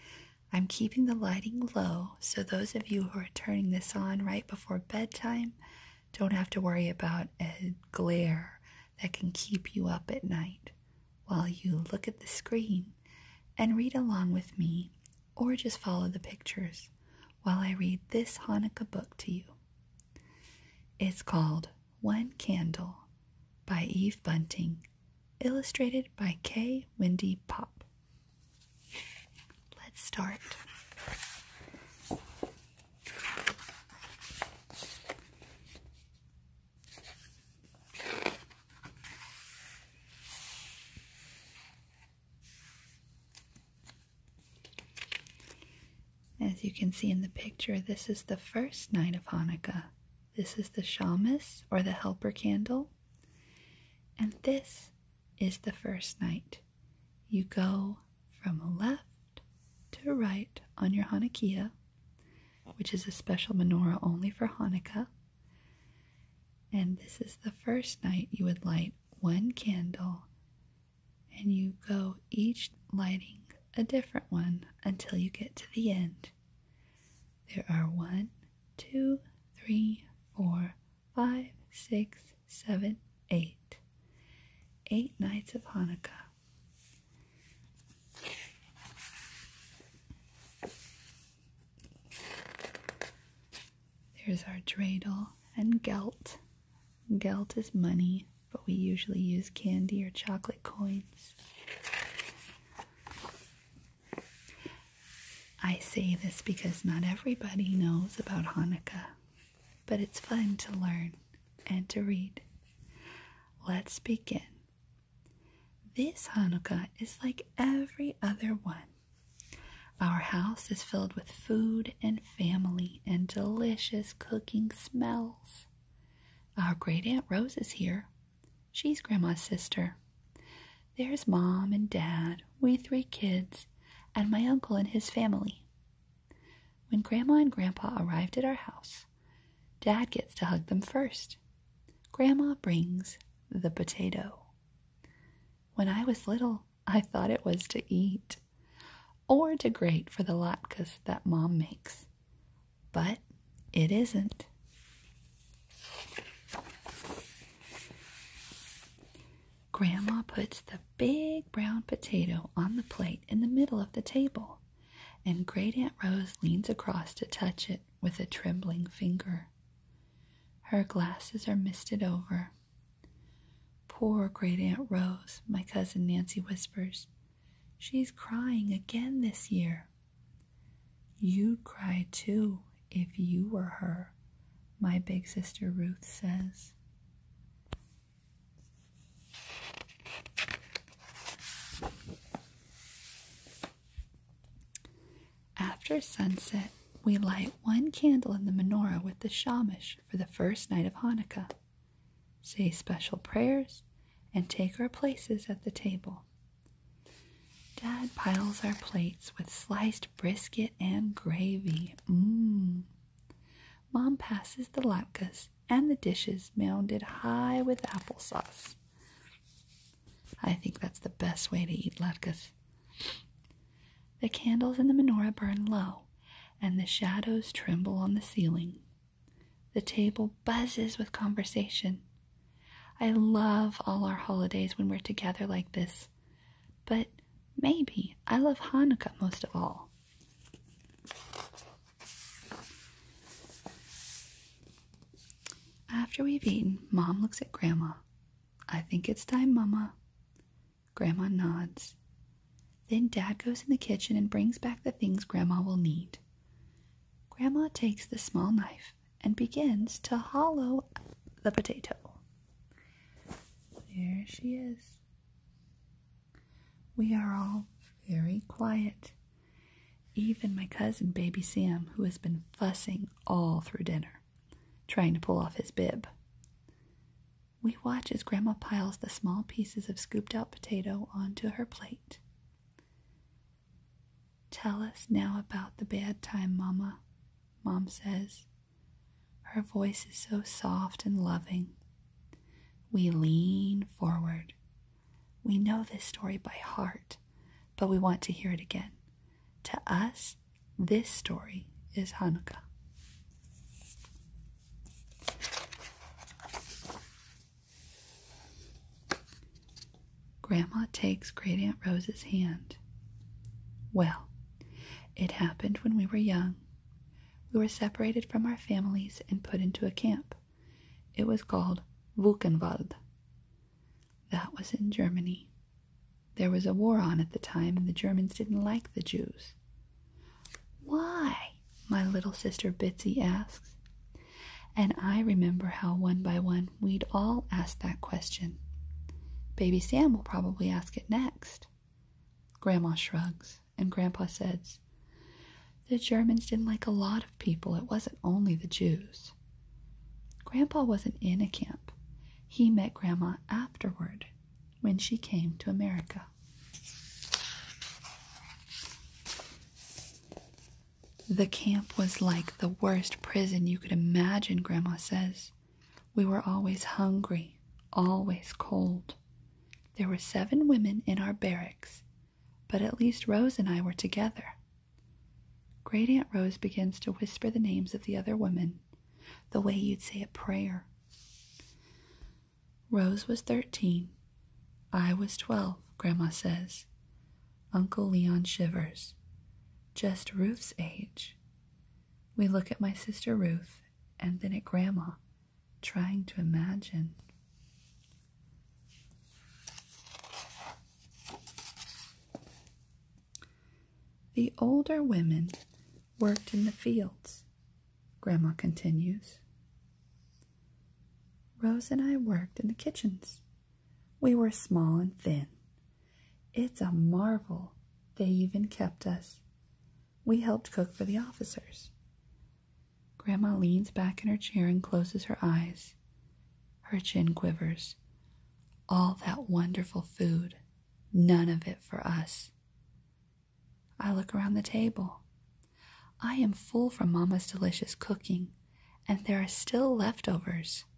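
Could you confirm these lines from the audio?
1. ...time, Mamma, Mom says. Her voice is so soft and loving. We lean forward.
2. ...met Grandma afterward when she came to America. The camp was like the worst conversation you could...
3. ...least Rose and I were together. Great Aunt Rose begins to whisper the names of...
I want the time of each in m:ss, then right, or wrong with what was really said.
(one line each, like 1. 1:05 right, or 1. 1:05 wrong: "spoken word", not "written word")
1. 4:46 right
2. 5:52 wrong: "prison", not "conversation"
3. 6:12 right.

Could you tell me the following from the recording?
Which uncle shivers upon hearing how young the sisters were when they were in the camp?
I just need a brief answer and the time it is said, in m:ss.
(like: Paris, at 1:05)
Leon, at 6:28.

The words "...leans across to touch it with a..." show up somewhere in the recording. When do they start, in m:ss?
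2:46.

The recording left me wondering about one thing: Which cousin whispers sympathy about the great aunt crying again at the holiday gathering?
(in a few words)
Nancy.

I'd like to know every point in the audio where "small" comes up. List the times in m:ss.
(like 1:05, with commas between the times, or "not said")
4:18, 4:39, 6:54.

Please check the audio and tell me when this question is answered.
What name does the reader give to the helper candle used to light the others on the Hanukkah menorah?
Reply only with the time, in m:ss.
0:50.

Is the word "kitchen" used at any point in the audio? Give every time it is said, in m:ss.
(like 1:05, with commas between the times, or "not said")
4:13, 6:52.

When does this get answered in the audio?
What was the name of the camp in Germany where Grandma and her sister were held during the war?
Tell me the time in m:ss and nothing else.
5:22.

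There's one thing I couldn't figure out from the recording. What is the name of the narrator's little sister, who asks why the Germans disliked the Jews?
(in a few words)
Bitsy.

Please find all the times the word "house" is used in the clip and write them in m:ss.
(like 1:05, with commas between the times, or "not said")
2:00, 2:18.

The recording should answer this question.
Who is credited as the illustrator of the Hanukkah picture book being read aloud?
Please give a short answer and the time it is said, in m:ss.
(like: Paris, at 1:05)
K. Wendy Popp, at 0:26.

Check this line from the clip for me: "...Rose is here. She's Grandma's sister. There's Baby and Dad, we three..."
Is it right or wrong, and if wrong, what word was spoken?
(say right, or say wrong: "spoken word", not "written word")
wrong: "Mom", not "Baby".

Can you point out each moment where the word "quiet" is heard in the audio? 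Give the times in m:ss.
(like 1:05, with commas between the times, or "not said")
4:28.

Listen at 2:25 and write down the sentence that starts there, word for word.
When I was little, I thought it was to eat or to grate for the latkes that Mom makes, but it isn't.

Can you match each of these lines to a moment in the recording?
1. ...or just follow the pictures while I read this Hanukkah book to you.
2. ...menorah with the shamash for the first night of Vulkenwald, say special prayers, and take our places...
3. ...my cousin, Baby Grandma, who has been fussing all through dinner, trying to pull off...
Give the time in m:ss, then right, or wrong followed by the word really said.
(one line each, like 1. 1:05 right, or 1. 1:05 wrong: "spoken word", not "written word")
1. 0:15 right
2. 3:18 wrong: "Hanukkah", not "Vulkenwald"
3. 4:30 wrong: "Sam", not "Grandma".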